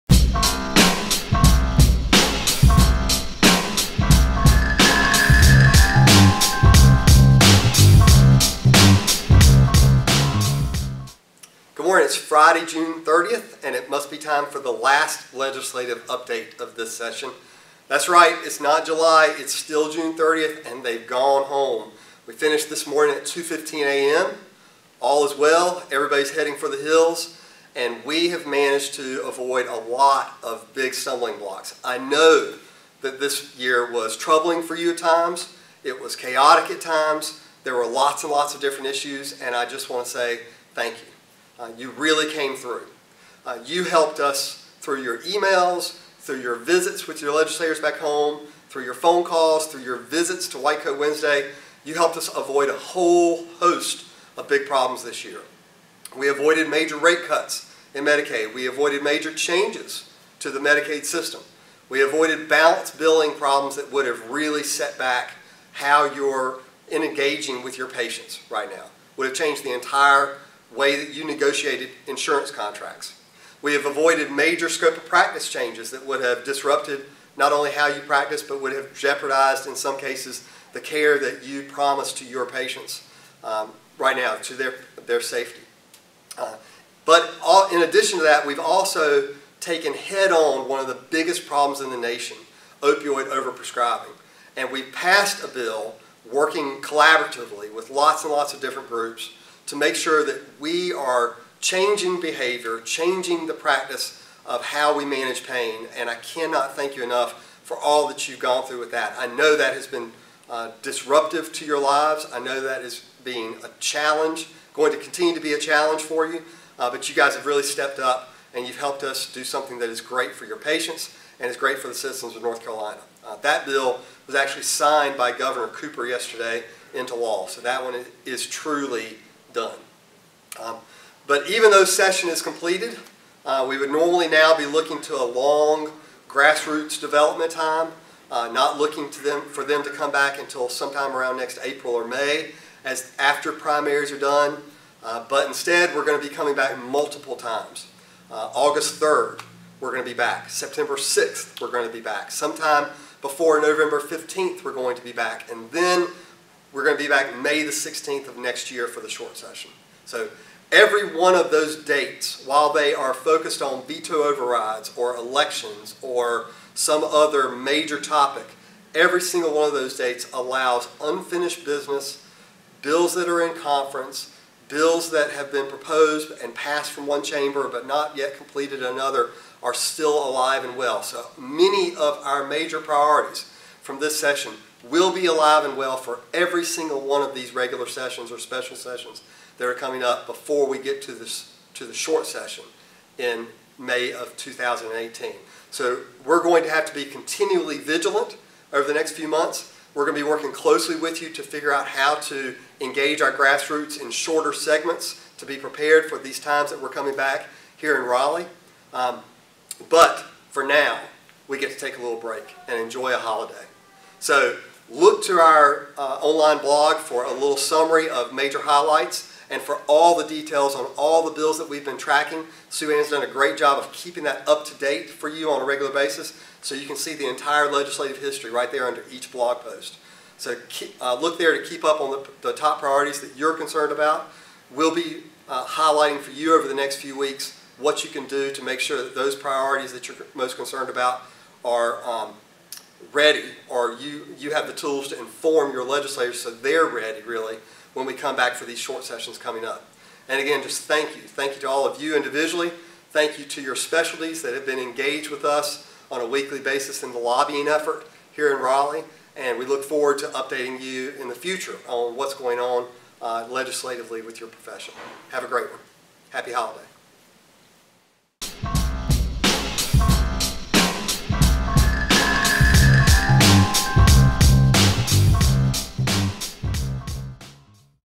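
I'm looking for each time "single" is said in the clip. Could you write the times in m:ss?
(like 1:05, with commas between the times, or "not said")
2:49, 3:06.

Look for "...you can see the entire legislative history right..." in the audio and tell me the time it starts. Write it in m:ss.
3:46.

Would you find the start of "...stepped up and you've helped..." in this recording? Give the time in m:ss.
1:57.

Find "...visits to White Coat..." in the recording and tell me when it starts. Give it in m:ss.
0:49.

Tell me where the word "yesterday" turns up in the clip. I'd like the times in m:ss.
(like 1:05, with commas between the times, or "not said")
2:06.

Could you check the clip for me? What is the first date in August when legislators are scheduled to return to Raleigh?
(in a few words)
August 3rd.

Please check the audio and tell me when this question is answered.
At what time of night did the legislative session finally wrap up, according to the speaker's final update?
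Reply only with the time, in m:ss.
0:23.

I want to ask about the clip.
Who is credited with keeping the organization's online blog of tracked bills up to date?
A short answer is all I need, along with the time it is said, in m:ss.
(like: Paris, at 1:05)
Sue Ann, at 3:42.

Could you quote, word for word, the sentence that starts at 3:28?
Um, but for now, we get to take a little break and enjoy a holiday.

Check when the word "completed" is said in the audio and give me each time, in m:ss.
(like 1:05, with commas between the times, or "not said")
2:12, 2:58.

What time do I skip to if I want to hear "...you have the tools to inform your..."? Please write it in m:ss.
4:04.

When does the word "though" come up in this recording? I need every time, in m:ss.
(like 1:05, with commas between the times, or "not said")
2:11.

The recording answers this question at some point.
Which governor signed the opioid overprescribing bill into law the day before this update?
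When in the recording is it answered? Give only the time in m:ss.
2:05.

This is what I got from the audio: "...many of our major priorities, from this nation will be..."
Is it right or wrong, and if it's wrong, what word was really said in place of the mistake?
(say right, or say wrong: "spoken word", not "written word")
wrong: "session", not "nation".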